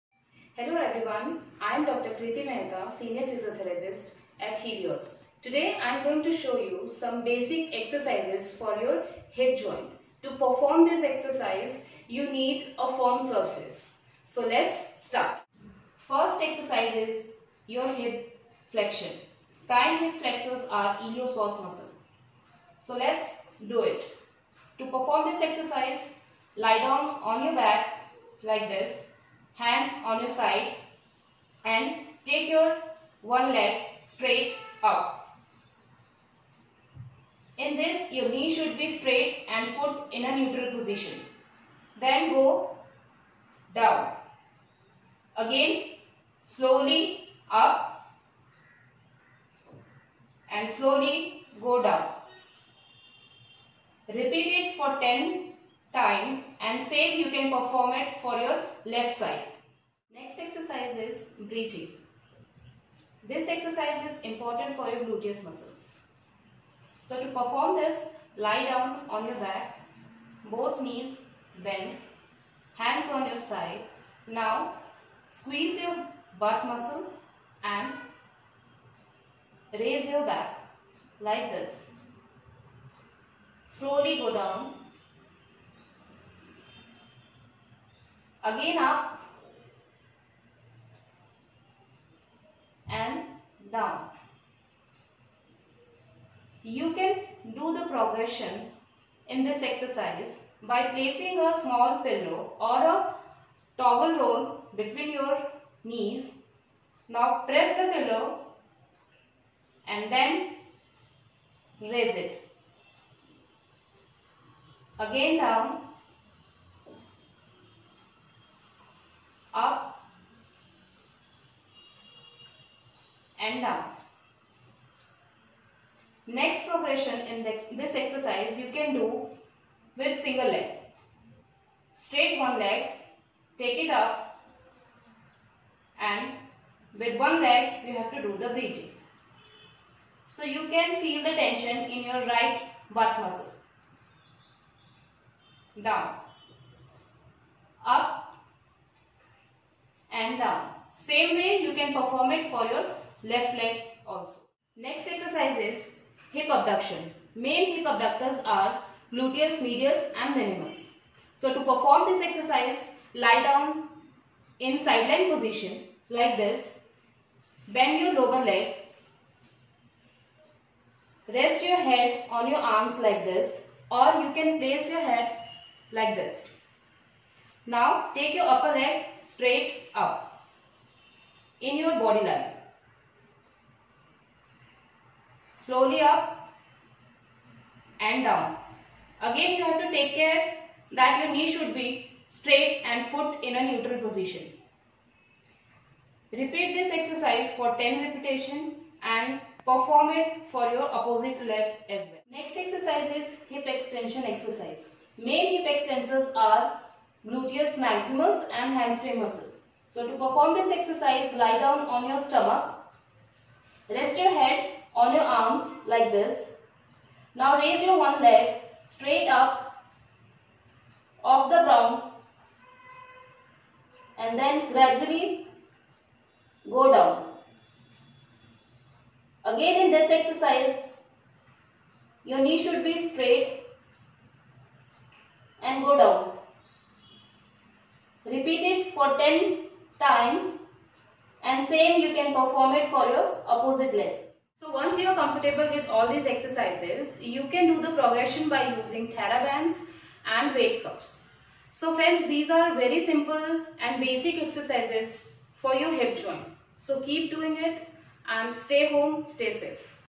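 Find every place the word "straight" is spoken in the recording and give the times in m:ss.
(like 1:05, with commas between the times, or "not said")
0:34, 0:38, 2:11, 2:59, 3:12, 3:38, 3:53.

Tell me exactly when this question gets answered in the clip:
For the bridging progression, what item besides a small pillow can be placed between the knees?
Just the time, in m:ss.
1:43.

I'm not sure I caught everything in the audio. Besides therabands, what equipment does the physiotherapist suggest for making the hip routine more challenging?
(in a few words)
weight cuffs.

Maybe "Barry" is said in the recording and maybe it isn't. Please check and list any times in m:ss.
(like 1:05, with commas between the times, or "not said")
not said.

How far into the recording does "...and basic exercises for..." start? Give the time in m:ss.
4:13.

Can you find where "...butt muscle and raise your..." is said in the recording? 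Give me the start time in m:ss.
1:16.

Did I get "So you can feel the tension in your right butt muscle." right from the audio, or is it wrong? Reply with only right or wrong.
right.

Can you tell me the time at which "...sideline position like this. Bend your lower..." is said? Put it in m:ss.
2:44.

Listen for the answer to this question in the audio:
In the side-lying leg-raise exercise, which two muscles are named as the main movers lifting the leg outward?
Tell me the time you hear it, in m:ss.
2:39.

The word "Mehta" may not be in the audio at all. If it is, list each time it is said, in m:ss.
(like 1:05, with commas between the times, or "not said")
0:02.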